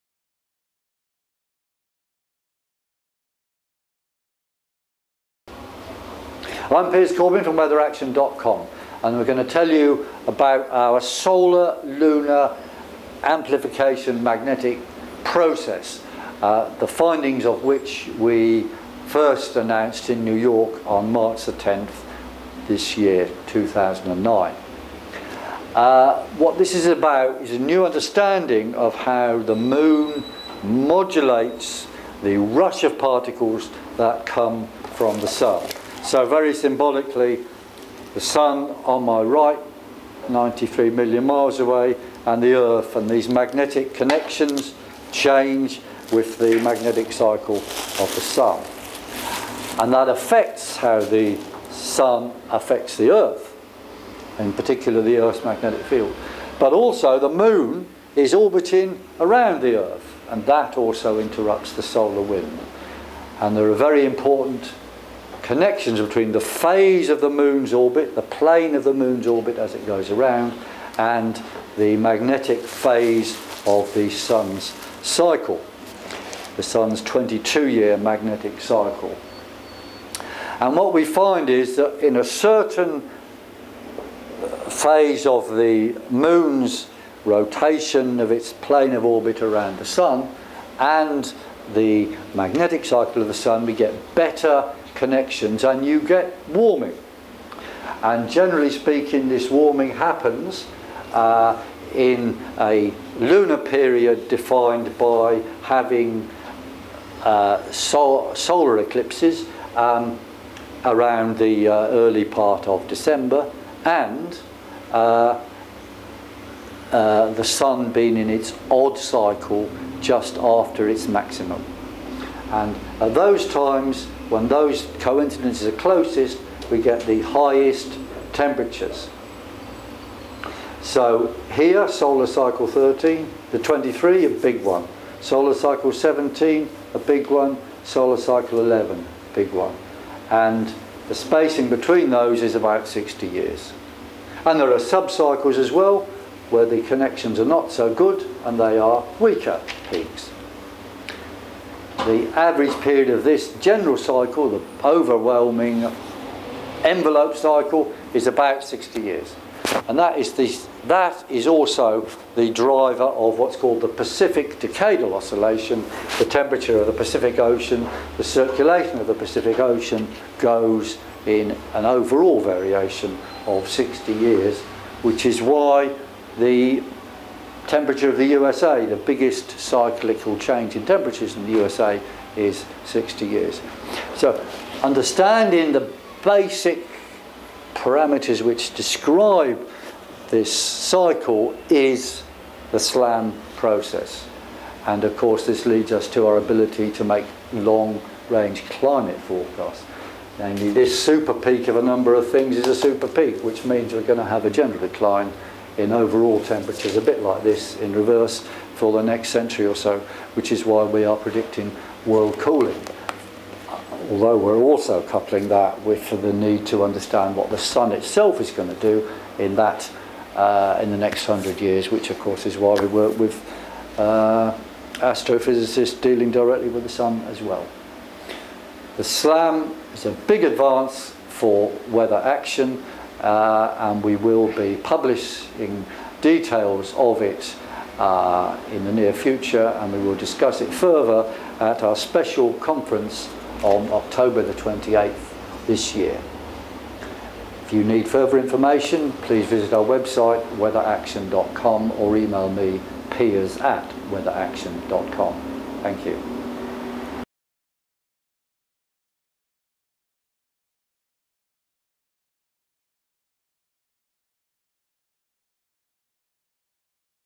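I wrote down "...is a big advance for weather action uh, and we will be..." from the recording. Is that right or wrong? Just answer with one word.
right.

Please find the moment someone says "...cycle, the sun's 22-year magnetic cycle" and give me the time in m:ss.
1:15.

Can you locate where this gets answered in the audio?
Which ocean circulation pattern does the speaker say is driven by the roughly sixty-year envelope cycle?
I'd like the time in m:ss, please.
2:43.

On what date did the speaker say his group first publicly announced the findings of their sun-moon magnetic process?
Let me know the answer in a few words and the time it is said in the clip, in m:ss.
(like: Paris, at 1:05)
March 10, at 0:21.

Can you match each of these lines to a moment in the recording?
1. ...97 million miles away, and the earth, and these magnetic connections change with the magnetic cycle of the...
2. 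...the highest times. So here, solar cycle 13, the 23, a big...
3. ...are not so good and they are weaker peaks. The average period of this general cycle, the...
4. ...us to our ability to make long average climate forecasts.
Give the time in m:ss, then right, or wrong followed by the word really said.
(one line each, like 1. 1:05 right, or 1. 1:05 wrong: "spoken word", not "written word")
1. 0:40 wrong: "93", not "97"
2. 2:07 wrong: "temperatures", not "times"
3. 2:27 right
4. 3:15 wrong: "range", not "average".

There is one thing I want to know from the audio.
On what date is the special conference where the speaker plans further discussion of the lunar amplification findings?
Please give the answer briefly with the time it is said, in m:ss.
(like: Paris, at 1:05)
October 28, at 4:03.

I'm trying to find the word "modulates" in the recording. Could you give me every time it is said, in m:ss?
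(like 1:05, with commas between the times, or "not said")
0:30.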